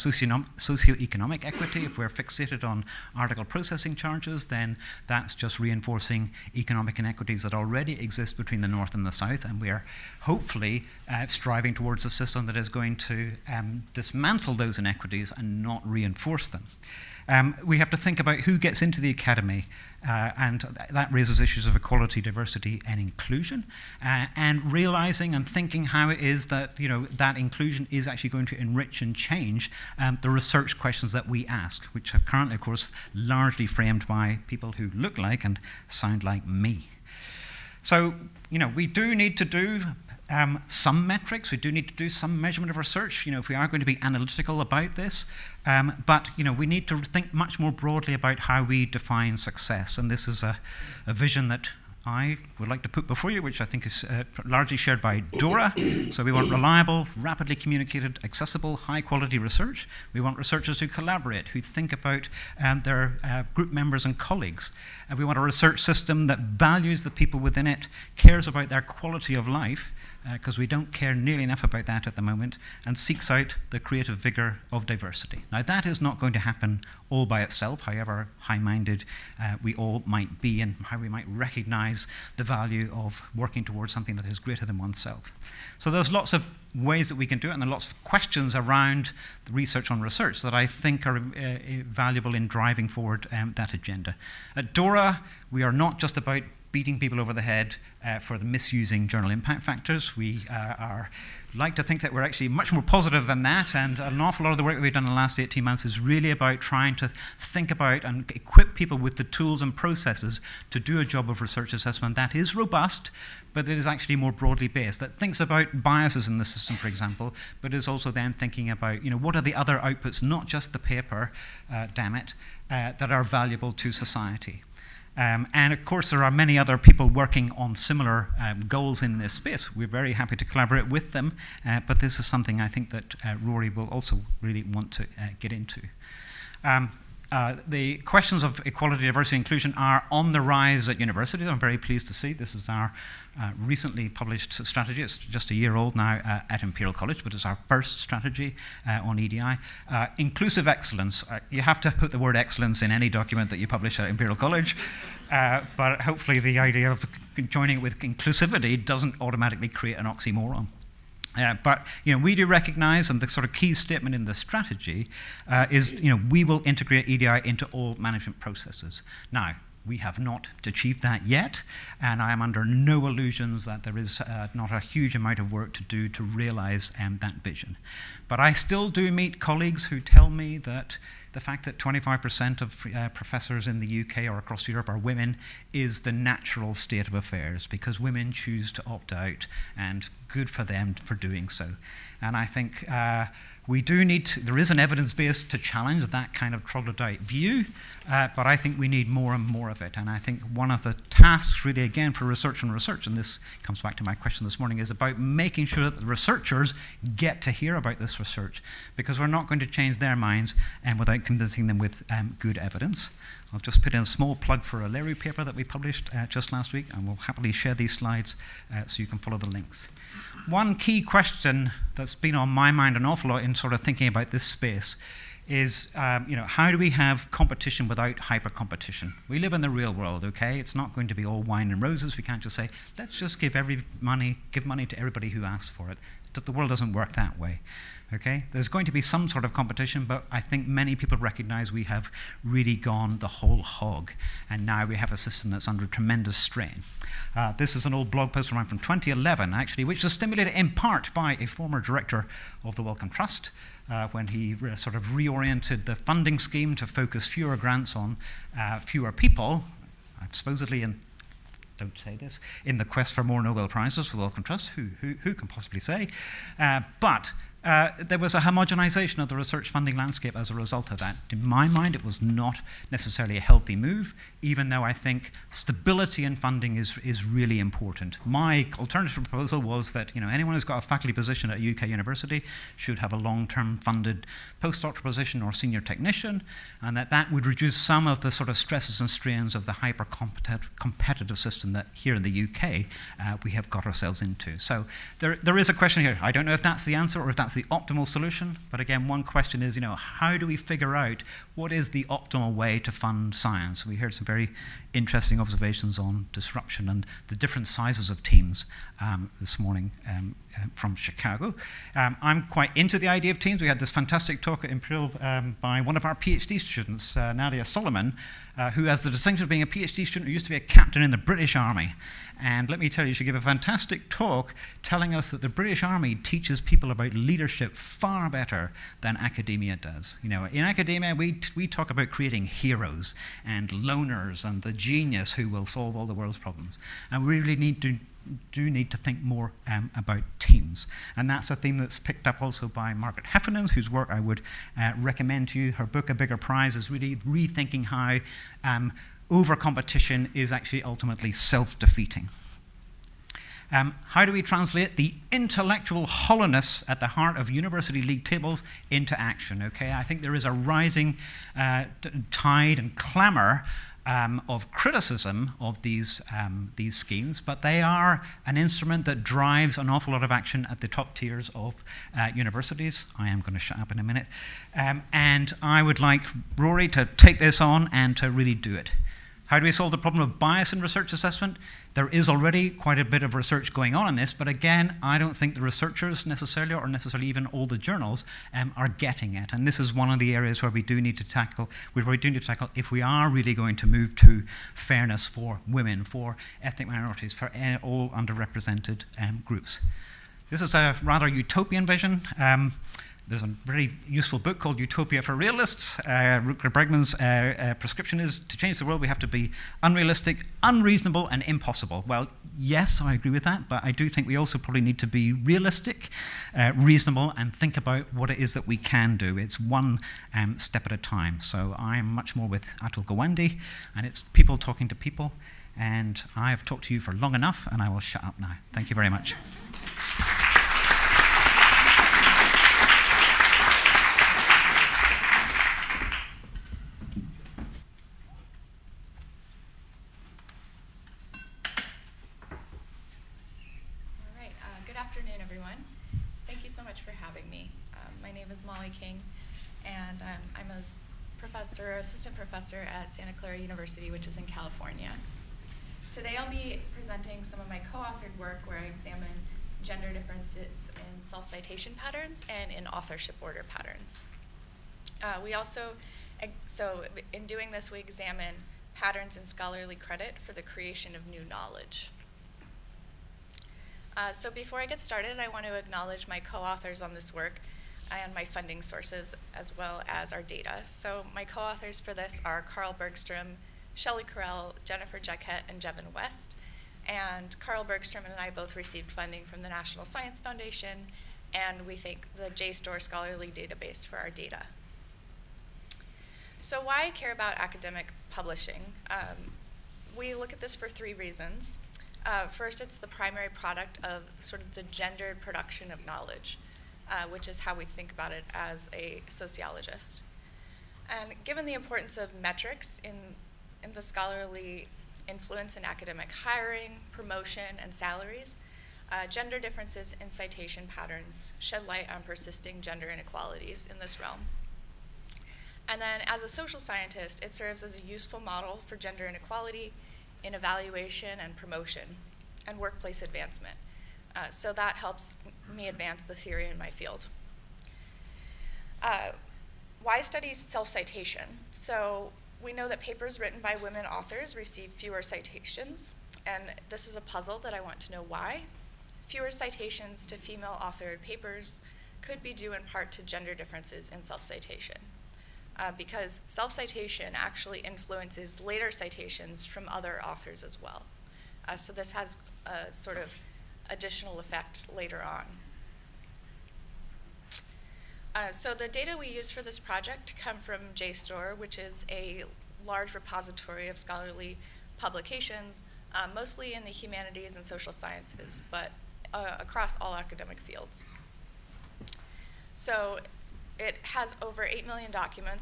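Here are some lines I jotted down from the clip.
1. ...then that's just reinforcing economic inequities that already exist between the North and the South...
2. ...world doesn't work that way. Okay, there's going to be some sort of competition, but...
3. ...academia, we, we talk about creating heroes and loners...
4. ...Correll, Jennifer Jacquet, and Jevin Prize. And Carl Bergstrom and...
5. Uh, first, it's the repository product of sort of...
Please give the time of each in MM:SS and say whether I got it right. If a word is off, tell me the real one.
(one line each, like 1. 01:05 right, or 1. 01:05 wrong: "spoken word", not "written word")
1. 00:04 right
2. 03:56 right
3. 05:30 right
4. 08:04 wrong: "West", not "Prize"
5. 08:22 wrong: "primary", not "repository".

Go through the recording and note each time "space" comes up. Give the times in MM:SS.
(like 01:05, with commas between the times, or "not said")
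02:09, 03:44.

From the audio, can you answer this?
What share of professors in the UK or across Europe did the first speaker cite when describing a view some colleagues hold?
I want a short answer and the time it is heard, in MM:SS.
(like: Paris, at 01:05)
25%, at 03:01.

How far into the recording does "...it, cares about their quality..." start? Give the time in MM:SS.
01:07.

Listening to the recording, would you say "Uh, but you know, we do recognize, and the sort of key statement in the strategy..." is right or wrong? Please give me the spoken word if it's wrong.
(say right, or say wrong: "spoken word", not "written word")
right.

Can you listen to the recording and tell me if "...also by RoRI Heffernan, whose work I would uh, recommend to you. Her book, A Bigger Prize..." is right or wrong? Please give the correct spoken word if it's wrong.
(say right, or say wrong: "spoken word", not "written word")
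wrong: "Margaret", not "RoRI".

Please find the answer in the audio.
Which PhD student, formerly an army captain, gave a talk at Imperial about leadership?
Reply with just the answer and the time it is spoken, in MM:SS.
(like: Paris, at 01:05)
Nadia Solomon, at 05:17.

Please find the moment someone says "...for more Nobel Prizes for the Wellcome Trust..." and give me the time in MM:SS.
04:23.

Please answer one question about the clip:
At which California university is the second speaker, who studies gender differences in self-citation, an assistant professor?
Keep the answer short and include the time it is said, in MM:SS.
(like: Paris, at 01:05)
Santa Clara University, at 07:33.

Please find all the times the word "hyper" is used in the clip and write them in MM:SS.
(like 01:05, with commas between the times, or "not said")
03:48, 04:49.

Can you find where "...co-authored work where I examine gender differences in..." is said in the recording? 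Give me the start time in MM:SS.
07:37.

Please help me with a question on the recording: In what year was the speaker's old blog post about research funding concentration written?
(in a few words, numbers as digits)
2011.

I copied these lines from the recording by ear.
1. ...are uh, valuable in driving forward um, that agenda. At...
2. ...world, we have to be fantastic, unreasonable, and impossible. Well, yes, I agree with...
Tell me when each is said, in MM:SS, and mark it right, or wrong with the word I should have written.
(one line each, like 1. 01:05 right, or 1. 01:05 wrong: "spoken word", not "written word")
1. 01:31 right
2. 06:48 wrong: "unrealistic", not "fantastic".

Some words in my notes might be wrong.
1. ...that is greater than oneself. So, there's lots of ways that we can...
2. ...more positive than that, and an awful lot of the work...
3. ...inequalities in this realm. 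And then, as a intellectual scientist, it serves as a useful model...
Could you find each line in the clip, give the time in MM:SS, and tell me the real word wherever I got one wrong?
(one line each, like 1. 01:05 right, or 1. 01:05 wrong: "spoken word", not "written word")
1. 01:24 right
2. 01:42 right
3. 08:43 wrong: "social", not "intellectual".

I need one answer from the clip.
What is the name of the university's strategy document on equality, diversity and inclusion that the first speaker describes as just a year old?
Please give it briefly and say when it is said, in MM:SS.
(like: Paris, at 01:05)
Inclusive excellence, at 02:30.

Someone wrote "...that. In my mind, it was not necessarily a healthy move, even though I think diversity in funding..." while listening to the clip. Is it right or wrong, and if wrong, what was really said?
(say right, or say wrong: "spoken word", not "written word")
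wrong: "stability", not "diversity".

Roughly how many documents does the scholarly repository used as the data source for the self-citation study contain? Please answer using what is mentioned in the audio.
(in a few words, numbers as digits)
over 8 million.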